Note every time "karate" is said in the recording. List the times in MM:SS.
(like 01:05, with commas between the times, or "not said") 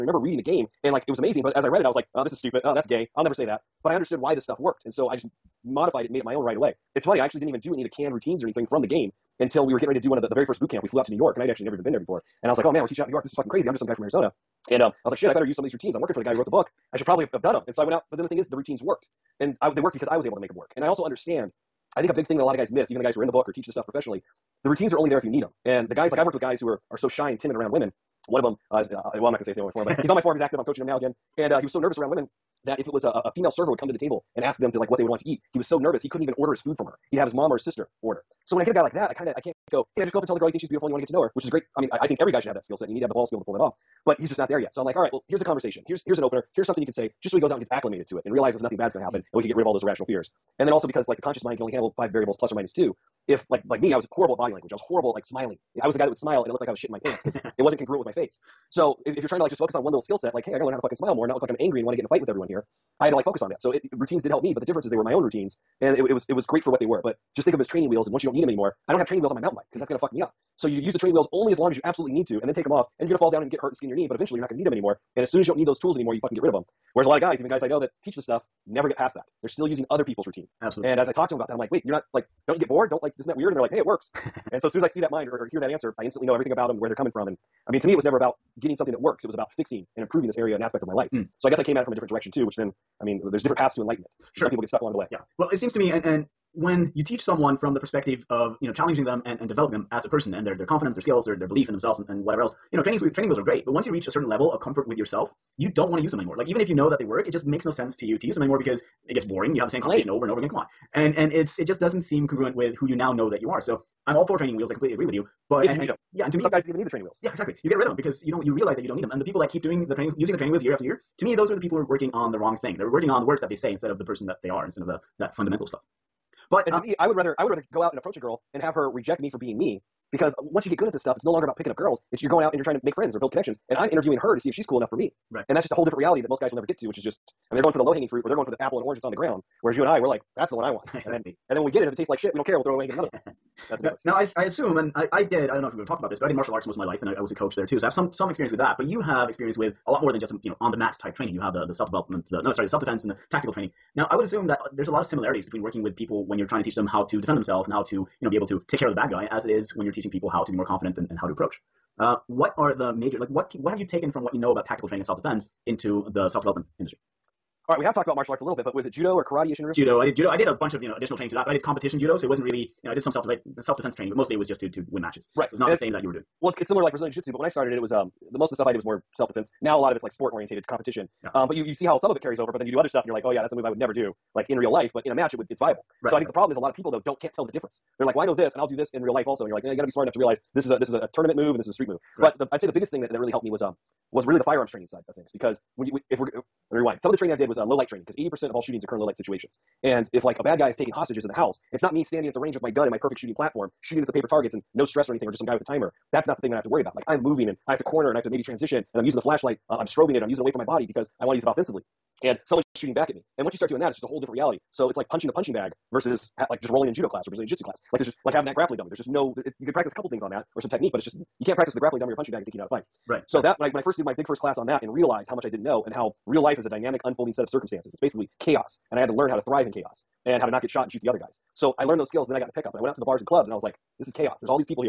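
02:49.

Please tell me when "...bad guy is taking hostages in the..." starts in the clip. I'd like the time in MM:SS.
03:20.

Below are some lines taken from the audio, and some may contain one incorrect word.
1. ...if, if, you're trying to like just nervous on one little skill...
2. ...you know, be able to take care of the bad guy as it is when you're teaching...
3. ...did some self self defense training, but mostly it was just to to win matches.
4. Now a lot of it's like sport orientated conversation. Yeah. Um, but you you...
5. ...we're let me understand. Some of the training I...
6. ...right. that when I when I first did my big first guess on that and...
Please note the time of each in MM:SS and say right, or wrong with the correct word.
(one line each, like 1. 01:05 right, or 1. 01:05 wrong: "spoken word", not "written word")
1. 00:59 wrong: "focus", not "nervous"
2. 02:38 right
3. 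02:52 right
4. 02:59 wrong: "competition", not "conversation"
5. 03:16 wrong: "rewind", not "understand"
6. 03:43 wrong: "class", not "guess".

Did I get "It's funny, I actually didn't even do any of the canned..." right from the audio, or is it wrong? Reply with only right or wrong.
right.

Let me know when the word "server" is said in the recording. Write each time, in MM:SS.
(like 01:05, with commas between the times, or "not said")
00:33.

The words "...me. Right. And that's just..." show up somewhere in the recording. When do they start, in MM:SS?
02:14.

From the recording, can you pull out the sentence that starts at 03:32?
And someone's shooting back at me.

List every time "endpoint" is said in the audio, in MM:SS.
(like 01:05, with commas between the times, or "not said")
not said.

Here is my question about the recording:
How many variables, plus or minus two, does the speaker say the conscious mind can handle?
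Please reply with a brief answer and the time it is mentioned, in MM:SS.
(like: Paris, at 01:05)
5, at 00:51.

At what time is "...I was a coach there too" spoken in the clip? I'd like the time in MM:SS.
02:27.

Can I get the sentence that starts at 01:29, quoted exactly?
It was about fixing and improving this area and aspect of my life.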